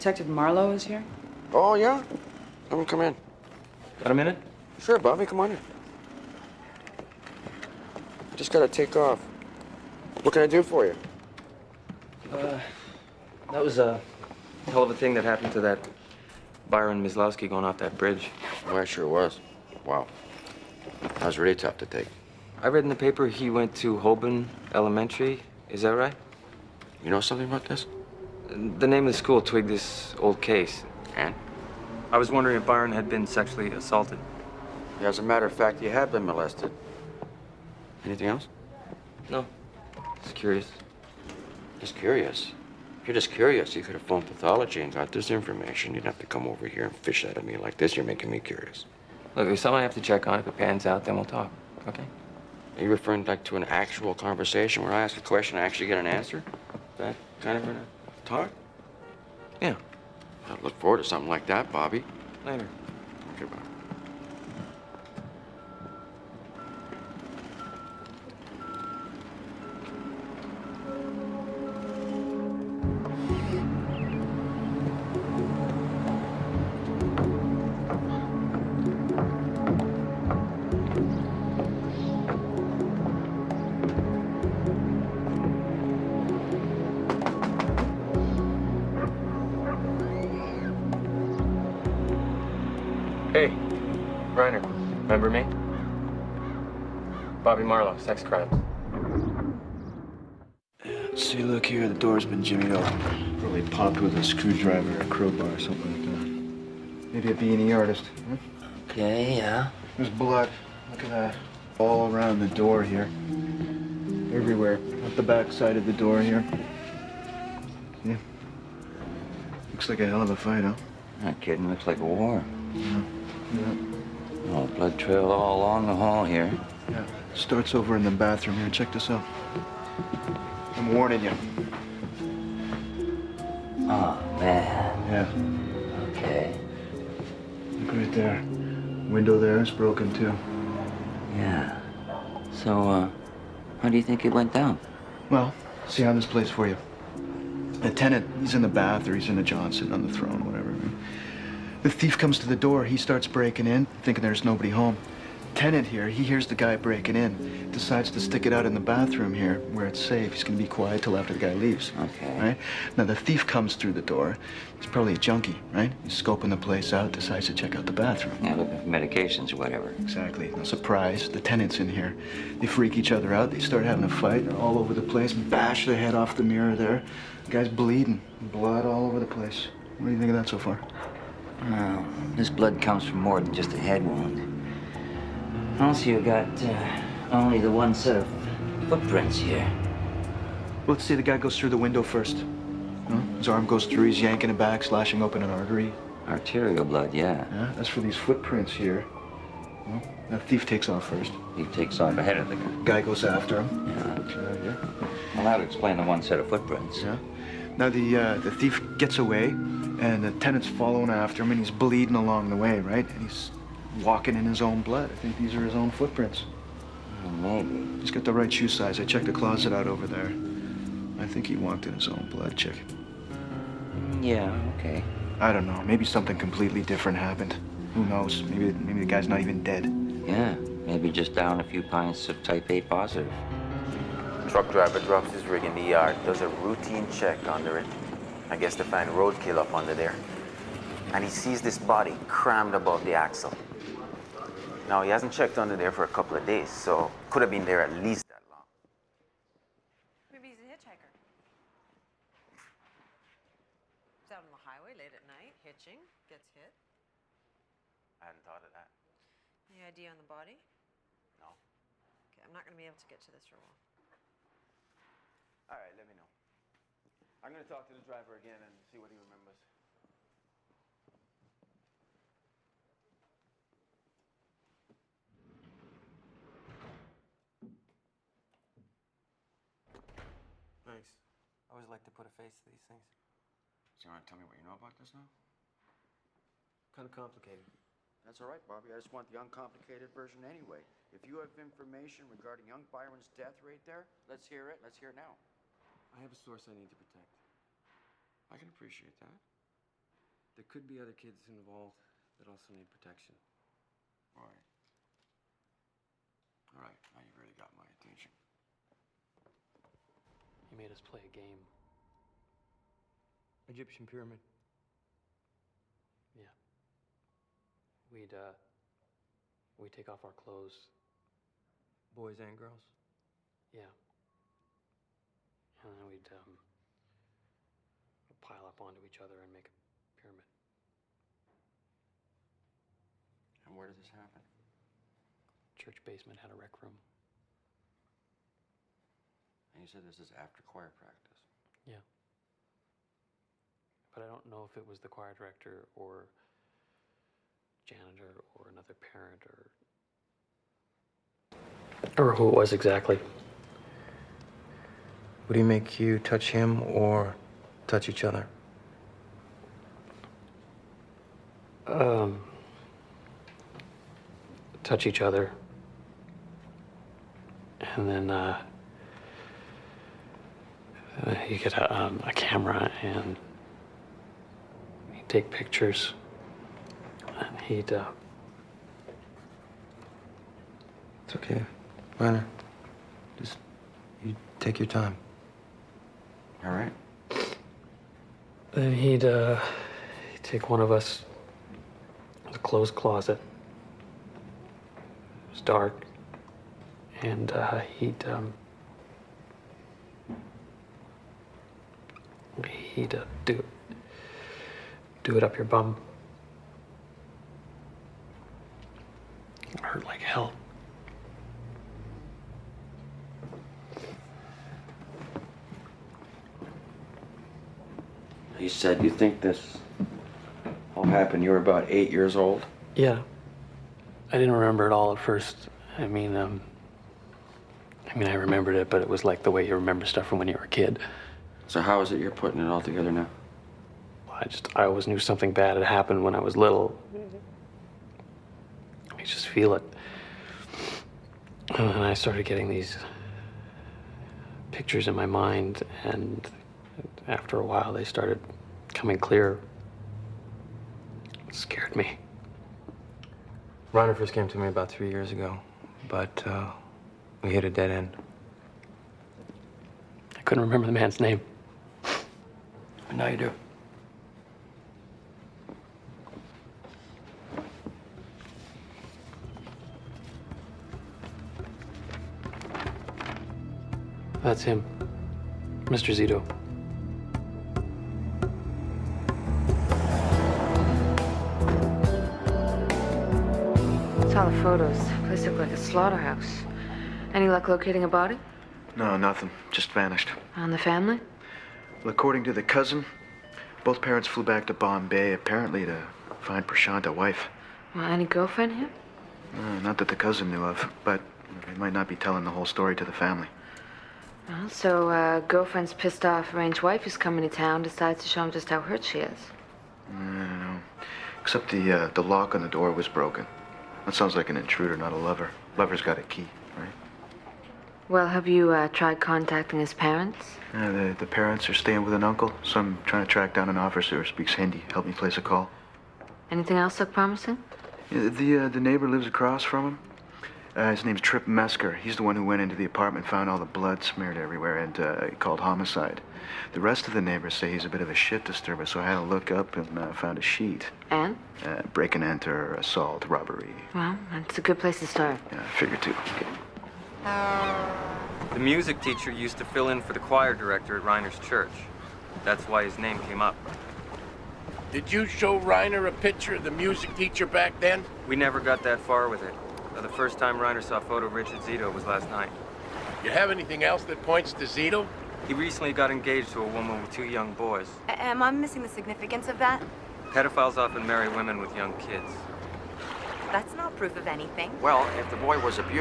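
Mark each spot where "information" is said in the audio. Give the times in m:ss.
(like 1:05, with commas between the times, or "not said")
0:45, 4:51.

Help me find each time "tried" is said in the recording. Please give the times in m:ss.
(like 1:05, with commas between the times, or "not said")
8:38.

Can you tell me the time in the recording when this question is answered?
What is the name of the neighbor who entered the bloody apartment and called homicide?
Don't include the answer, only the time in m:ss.
8:51.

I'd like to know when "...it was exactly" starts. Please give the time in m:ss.
5:52.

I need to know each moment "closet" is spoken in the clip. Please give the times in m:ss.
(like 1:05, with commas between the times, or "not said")
3:39, 6:32.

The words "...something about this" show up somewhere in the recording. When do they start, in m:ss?
0:27.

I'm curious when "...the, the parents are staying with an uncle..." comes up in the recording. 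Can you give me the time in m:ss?
8:40.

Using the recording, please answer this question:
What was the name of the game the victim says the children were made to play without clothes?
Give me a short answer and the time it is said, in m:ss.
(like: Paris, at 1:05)
Egyptian pyramid, at 5:13.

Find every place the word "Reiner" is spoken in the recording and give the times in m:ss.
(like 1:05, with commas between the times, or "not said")
9:11, 9:15, 9:20.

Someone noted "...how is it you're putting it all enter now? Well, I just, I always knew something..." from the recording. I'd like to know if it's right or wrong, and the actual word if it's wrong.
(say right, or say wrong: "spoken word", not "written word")
wrong: "together", not "enter".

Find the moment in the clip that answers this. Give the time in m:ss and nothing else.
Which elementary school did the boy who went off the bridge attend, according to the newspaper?
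0:23.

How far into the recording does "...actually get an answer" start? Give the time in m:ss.
0:55.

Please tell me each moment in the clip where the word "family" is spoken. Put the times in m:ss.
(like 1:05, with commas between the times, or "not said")
8:10, 8:23.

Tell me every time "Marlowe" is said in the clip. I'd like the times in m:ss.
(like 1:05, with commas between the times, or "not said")
0:00, 1:37.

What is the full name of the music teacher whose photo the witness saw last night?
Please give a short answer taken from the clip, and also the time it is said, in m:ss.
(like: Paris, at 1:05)
Richard Zito, at 9:21.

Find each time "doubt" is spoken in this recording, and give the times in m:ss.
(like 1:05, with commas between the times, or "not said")
not said.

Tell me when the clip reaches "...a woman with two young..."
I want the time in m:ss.
9:26.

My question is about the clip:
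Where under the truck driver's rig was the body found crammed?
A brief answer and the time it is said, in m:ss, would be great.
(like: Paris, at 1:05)
Above the axle, at 4:02.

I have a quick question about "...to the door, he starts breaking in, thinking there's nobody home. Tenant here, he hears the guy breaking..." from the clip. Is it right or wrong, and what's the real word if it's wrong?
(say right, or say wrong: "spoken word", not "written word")
right.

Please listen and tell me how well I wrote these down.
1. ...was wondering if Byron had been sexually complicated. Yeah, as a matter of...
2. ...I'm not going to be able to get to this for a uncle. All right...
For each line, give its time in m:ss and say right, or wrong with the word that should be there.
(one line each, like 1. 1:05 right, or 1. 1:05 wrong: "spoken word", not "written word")
1. 0:32 wrong: "assaulted", not "complicated"
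2. 4:22 wrong: "while", not "uncle".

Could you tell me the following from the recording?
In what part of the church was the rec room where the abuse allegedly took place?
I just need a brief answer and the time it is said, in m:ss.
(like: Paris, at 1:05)
Church basement, at 5:35.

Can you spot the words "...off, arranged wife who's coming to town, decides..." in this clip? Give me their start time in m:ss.
8:26.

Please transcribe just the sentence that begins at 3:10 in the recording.
Let's see, the guy goes through the window first.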